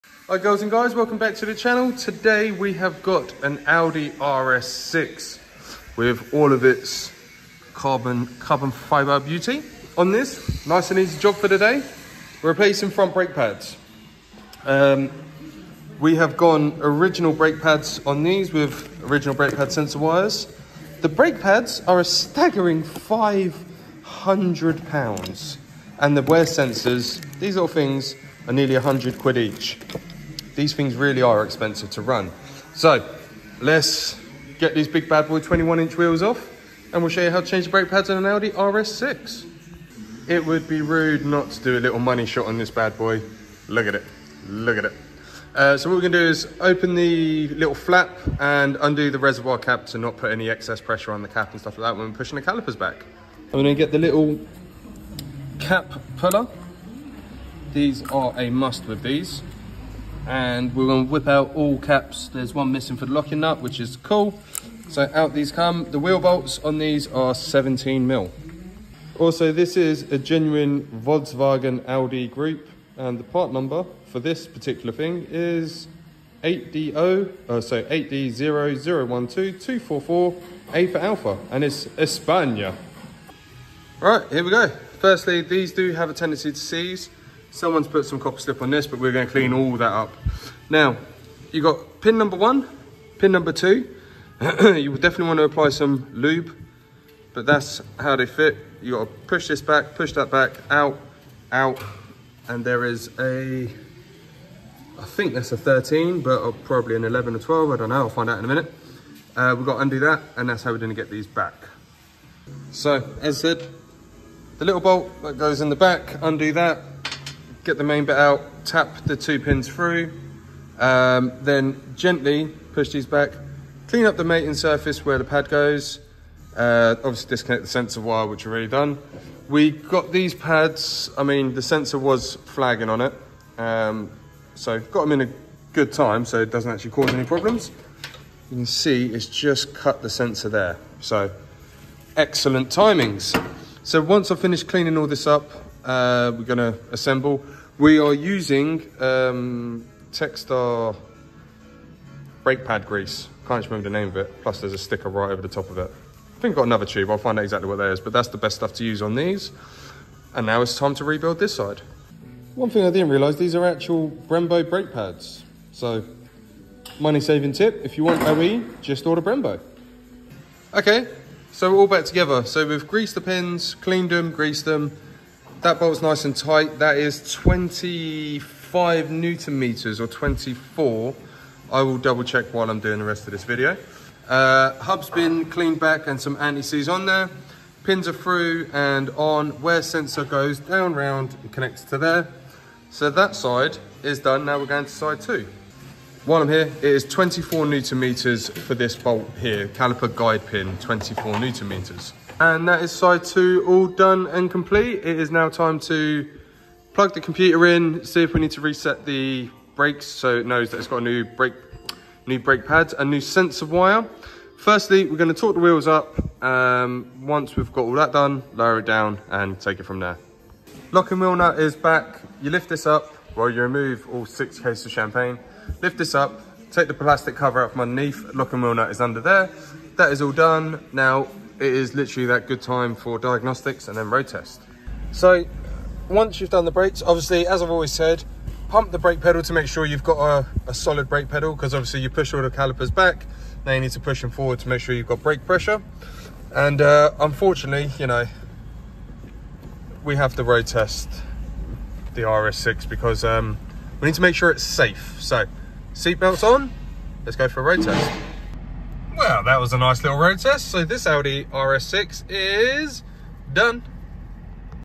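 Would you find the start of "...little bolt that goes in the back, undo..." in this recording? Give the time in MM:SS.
01:54.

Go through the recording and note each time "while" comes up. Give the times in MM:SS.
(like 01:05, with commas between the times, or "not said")
03:02, 03:16.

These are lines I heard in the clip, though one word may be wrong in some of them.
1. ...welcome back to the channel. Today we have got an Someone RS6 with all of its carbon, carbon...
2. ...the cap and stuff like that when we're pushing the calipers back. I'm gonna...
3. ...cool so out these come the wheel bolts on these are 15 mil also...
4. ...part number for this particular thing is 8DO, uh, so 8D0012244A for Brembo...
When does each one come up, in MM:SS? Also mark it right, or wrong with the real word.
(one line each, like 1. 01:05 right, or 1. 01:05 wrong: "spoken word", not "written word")
1. 00:00 wrong: "Audi", not "Someone"
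2. 00:51 right
3. 01:03 wrong: "17", not "15"
4. 01:13 wrong: "Alpha", not "Brembo".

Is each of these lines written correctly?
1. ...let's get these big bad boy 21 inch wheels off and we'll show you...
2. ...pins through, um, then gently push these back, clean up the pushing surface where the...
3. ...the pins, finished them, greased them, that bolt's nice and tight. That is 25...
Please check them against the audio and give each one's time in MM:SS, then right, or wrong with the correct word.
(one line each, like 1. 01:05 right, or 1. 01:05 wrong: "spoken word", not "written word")
1. 00:33 right
2. 01:59 wrong: "mating", not "pushing"
3. 02:53 wrong: "cleaned", not "finished".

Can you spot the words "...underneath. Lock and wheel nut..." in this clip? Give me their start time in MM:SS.
03:47.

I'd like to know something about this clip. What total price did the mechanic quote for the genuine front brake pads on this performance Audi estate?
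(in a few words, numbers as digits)
500 pounds.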